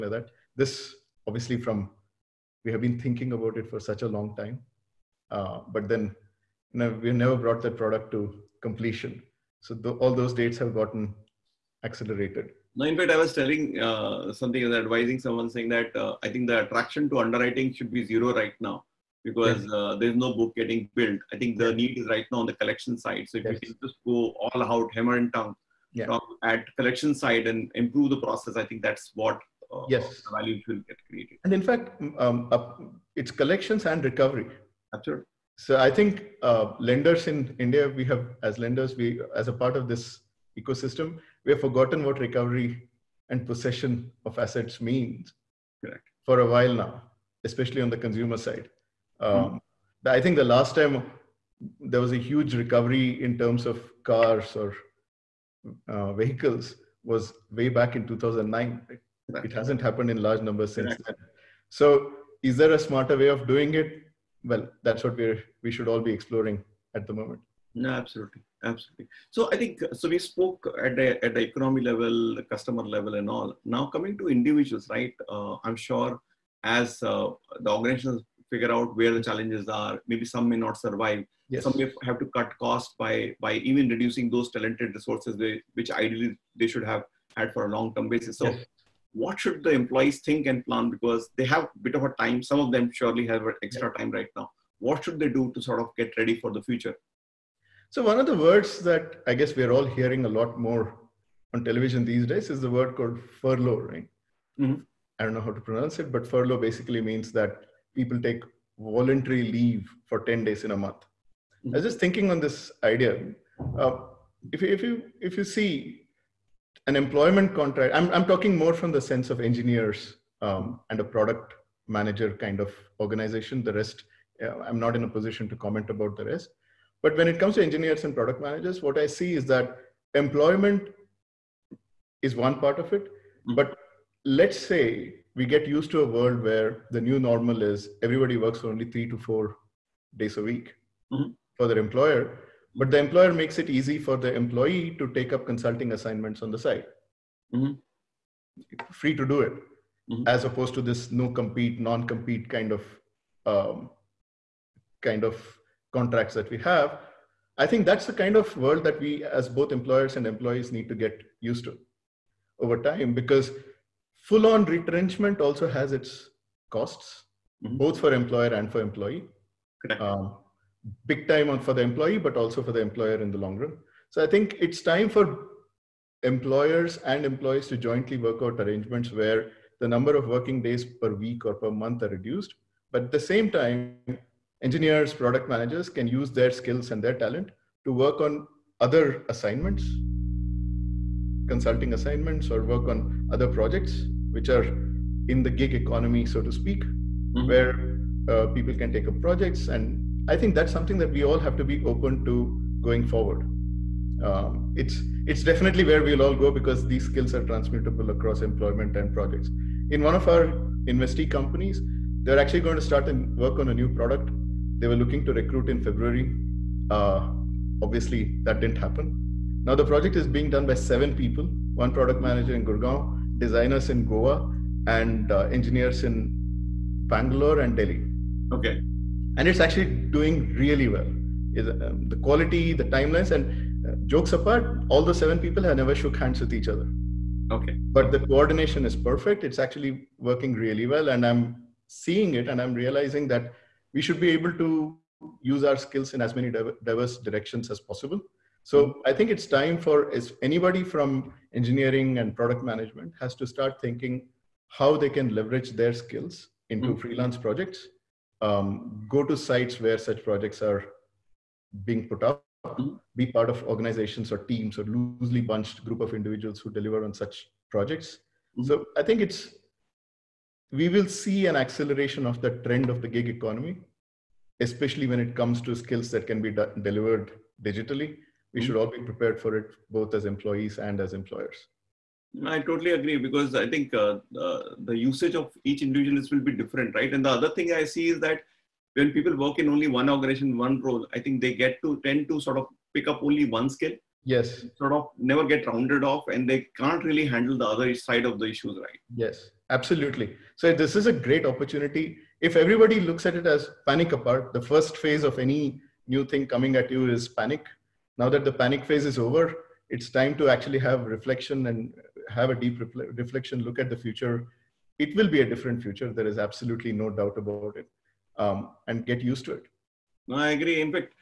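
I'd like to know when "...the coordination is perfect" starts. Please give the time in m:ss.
3:58.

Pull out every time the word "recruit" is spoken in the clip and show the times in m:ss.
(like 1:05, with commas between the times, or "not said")
3:35.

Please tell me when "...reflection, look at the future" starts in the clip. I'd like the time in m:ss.
5:13.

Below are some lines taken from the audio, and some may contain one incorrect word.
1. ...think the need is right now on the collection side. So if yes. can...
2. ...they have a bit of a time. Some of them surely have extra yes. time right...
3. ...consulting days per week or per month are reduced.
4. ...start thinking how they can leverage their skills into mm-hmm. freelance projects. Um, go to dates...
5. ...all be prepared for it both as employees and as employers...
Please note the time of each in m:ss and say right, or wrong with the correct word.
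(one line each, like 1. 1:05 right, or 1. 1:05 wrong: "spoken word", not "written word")
1. 0:21 right
2. 1:31 right
3. 3:00 wrong: "working", not "consulting"
4. 4:13 wrong: "sites", not "dates"
5. 4:38 right.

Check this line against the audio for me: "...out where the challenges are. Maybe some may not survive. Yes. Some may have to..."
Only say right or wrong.
right.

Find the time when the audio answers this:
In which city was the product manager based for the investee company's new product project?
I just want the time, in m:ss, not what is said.
3:42.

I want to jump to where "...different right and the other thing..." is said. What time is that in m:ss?
4:46.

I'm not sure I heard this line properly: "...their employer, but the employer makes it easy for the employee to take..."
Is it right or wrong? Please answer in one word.
right.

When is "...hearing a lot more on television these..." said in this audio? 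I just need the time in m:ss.
1:39.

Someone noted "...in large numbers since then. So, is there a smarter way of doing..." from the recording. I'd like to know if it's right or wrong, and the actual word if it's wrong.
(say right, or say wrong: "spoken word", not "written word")
right.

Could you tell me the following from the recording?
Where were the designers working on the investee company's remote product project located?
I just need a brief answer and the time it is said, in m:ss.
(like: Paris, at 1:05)
Goa, at 3:44.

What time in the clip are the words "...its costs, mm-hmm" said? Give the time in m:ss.
2:45.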